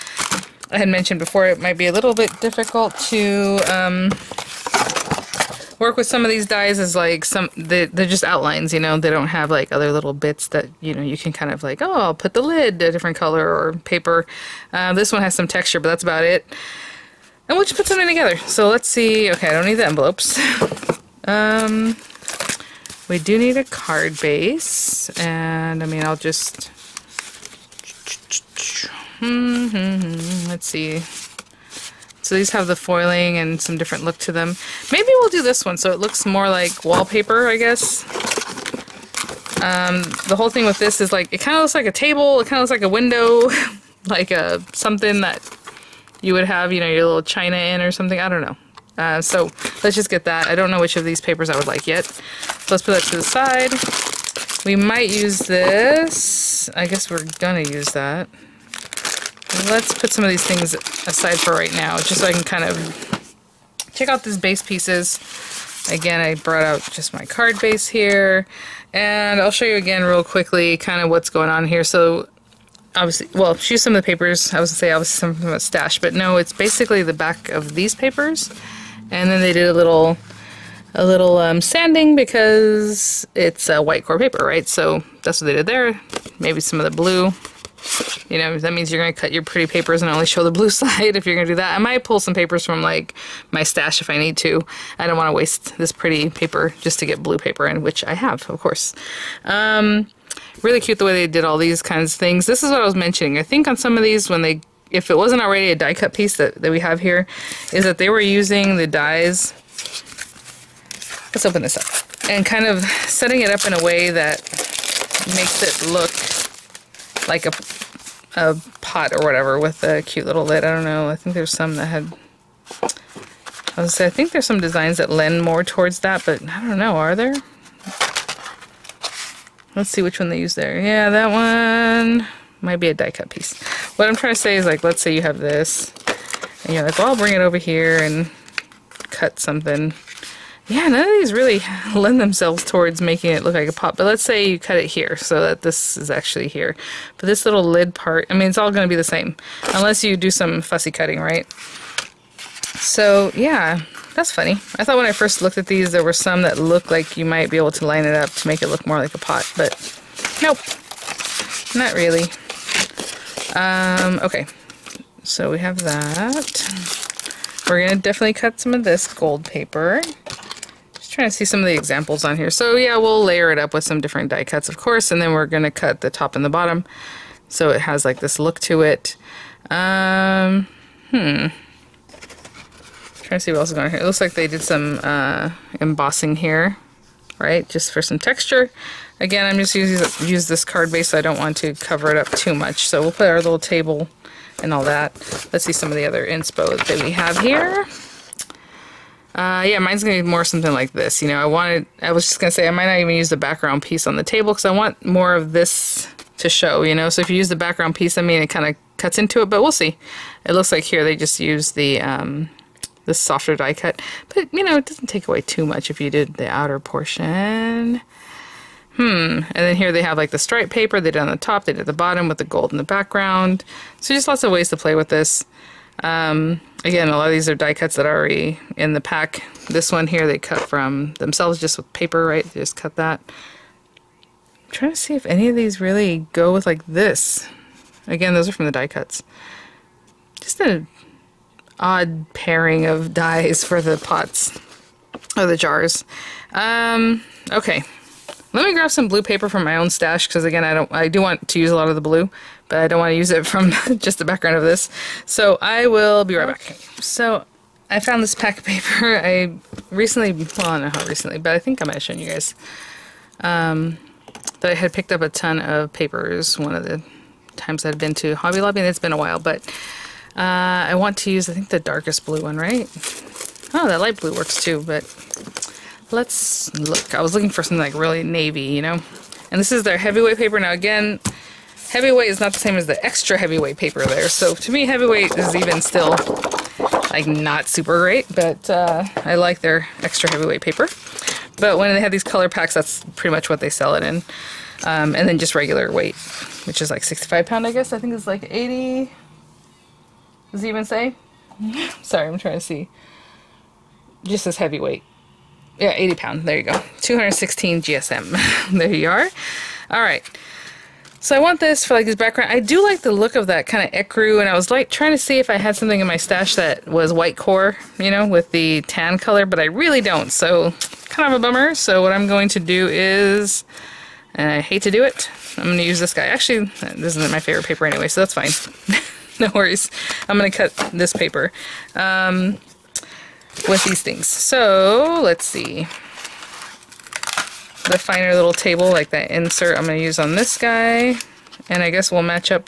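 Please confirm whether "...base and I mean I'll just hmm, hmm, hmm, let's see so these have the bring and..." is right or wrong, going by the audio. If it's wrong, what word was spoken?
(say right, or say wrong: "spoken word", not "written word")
wrong: "foiling", not "bring".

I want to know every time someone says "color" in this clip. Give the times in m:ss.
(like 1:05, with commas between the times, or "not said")
0:13, 4:52, 5:19.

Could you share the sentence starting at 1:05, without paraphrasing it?
Again, I brought out just my card base here, and I'll show you again real quickly kind of what's going on here.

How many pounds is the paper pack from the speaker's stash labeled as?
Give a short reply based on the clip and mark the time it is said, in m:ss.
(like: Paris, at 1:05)
80 pound, at 5:05.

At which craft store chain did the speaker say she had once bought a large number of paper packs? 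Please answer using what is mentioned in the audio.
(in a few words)
Hobby Lobby.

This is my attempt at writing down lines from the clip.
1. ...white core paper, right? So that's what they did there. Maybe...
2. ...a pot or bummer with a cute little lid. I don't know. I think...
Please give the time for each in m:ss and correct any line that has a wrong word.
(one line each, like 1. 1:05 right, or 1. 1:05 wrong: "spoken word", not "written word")
1. 1:23 right
2. 1:58 wrong: "whatever", not "bummer".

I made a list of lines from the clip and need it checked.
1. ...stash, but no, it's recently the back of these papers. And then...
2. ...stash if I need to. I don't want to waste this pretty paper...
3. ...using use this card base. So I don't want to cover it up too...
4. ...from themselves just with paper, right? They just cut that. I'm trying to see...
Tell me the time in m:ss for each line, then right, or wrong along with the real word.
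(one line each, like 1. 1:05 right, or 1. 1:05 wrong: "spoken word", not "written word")
1. 1:15 wrong: "basically", not "recently"
2. 1:33 right
3. 3:09 right
4. 3:50 right.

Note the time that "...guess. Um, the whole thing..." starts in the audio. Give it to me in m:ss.
0:37.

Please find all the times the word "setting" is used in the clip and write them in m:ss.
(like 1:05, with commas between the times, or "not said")
1:53.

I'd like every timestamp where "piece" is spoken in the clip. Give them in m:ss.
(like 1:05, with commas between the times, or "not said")
1:04, 1:46, 2:13, 3:23, 3:27.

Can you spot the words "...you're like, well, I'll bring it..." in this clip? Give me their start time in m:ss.
2:16.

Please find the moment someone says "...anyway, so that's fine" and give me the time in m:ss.
5:27.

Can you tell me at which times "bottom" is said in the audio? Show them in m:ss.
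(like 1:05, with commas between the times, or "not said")
2:56, 3:41.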